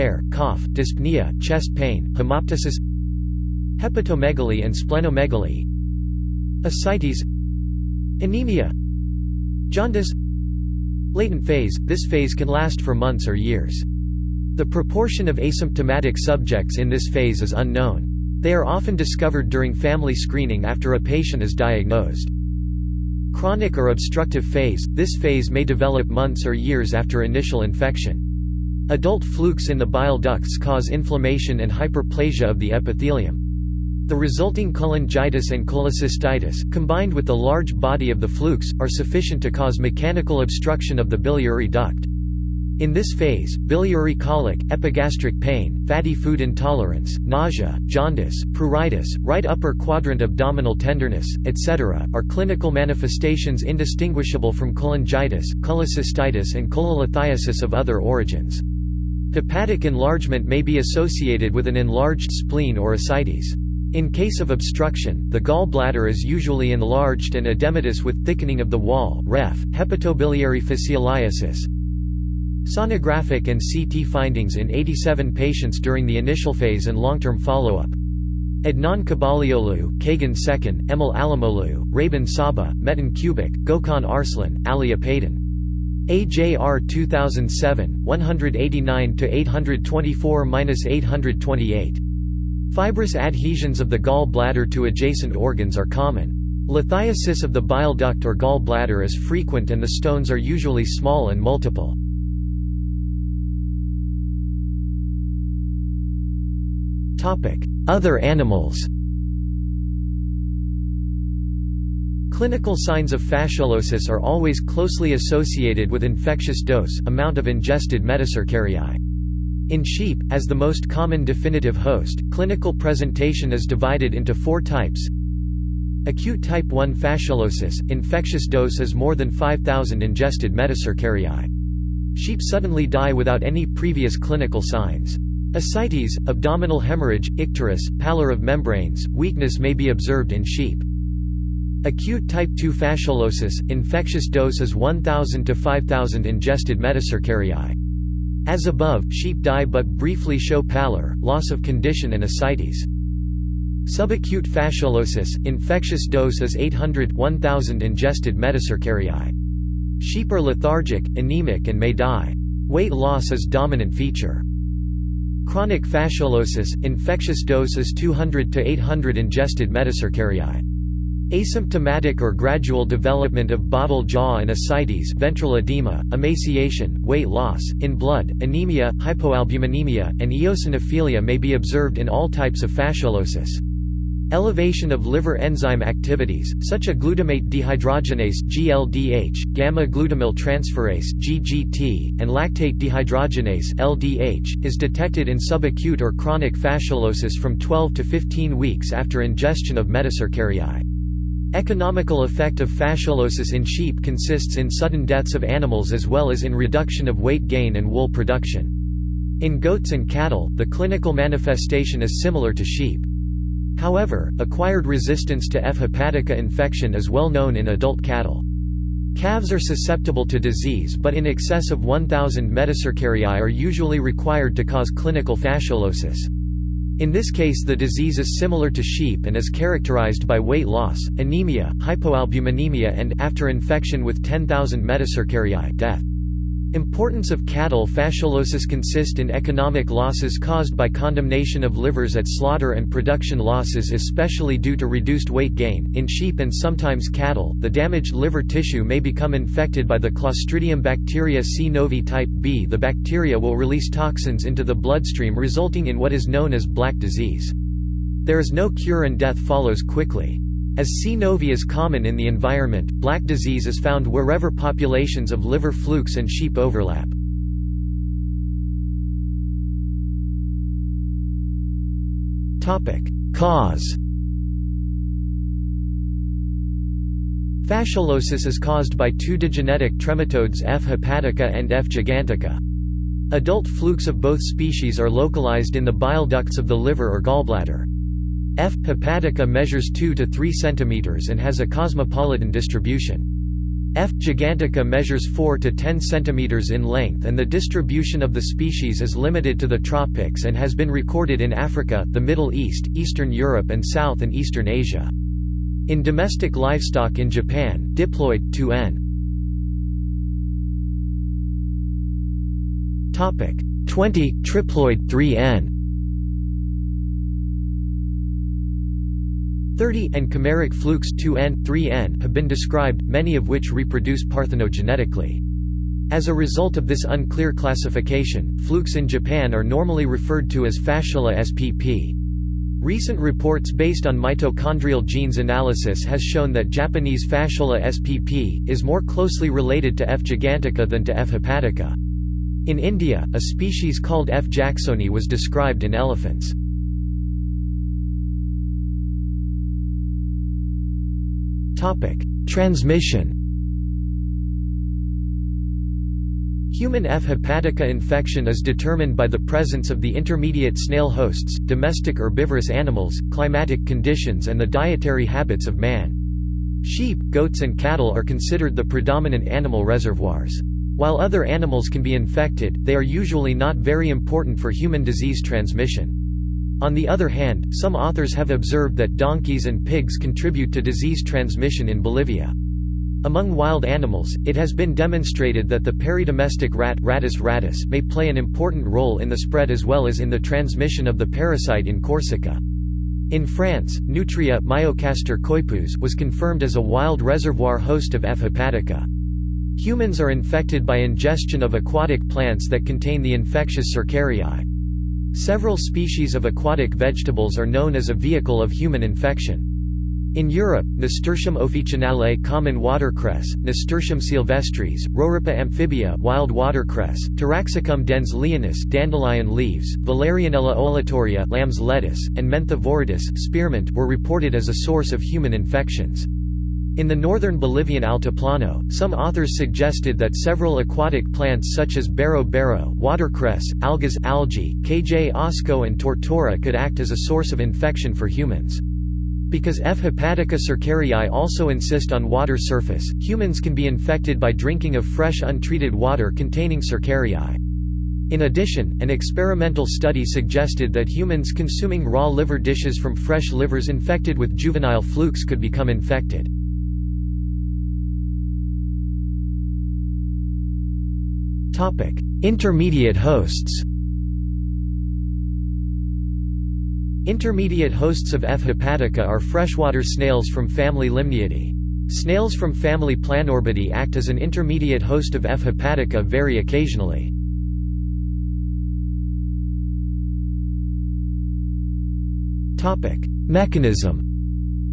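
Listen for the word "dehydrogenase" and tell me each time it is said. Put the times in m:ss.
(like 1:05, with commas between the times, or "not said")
3:07, 3:12.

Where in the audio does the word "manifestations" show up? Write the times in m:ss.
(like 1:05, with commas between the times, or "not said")
0:52, 3:31.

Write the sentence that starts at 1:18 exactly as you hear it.
Adnan Kabaalioğlu, Kağan Çeken, Emel Alimoğlu, Rabin Saba, Metin Çubuk, Gokhan Arslan, Ali Apaydin.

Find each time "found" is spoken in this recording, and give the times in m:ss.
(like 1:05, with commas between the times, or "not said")
4:23.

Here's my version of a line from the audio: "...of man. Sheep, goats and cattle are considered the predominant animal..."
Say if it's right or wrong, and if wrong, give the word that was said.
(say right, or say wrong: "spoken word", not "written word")
right.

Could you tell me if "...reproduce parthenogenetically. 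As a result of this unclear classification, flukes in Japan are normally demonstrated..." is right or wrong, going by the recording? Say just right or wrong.
wrong.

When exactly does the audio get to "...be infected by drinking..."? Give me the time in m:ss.
7:23.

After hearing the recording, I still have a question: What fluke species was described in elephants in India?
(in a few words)
F. jacksoni.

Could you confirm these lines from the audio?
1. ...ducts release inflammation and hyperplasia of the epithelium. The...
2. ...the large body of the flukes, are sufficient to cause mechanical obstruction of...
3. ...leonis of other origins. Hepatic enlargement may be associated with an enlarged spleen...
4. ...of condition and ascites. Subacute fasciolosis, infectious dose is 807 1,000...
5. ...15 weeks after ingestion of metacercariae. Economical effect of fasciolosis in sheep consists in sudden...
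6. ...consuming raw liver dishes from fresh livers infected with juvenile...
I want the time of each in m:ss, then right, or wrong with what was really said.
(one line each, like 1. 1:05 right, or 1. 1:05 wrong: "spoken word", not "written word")
1. 0:30 wrong: "cause", not "release"
2. 0:37 right
3. 0:56 wrong: "cholelithiasis", not "leonis"
4. 2:31 wrong: "800", not "807"
5. 3:18 right
6. 7:31 right.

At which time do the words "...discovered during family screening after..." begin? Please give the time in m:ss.
0:18.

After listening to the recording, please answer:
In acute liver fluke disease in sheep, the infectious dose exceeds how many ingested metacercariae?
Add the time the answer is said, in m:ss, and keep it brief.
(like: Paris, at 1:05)
5,000, at 2:08.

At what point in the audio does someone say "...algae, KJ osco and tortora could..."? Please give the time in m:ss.
7:14.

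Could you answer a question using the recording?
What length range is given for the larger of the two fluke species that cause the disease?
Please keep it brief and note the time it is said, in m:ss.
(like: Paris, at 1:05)
4 to 10 cm, at 4:55.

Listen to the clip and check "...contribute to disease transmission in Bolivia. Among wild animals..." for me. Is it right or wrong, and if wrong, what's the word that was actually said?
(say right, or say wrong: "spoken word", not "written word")
right.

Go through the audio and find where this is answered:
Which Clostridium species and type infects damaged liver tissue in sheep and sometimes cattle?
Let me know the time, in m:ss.
4:11.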